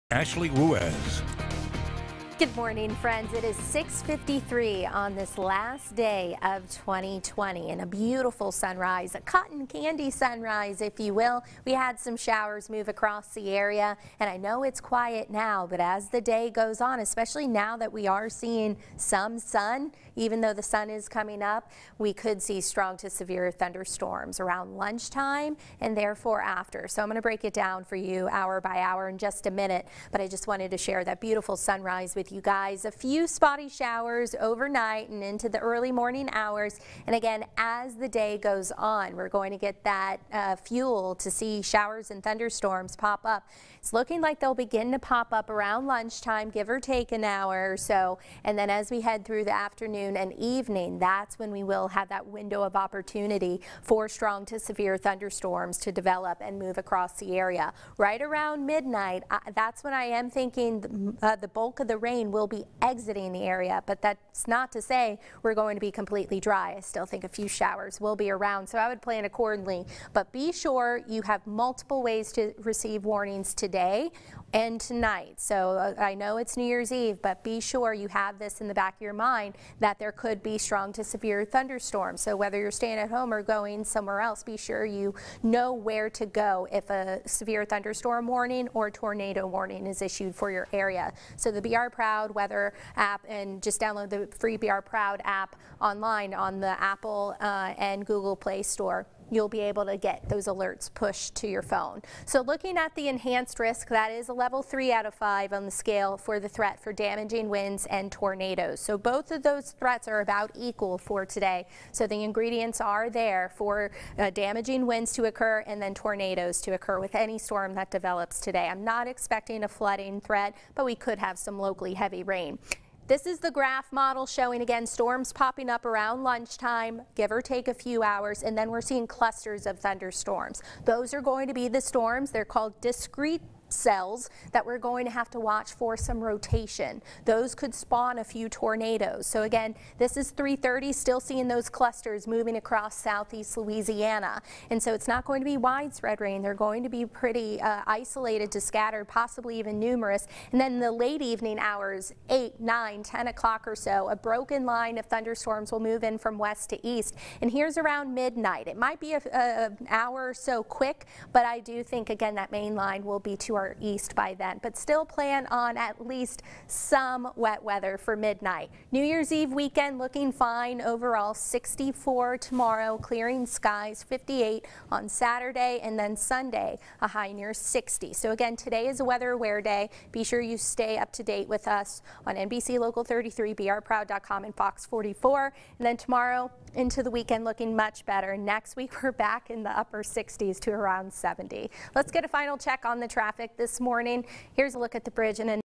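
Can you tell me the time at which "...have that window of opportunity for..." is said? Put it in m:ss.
0:51.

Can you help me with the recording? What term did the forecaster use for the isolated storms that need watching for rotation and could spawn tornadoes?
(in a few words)
discrete cells.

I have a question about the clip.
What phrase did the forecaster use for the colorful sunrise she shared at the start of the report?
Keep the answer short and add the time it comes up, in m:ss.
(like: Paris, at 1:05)
cotton candy sunrise, at 0:09.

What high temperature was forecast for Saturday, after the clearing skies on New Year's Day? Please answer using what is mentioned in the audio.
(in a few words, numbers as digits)
58.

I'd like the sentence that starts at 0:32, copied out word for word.
A few spotty showers overnight and into the early morning hours.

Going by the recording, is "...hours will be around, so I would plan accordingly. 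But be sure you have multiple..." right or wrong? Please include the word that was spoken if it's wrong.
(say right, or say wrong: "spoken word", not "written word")
wrong: "showers", not "hours".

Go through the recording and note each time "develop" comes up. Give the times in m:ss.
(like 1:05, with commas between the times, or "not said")
0:55, 1:57.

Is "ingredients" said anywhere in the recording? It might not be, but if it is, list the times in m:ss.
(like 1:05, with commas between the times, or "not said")
1:52.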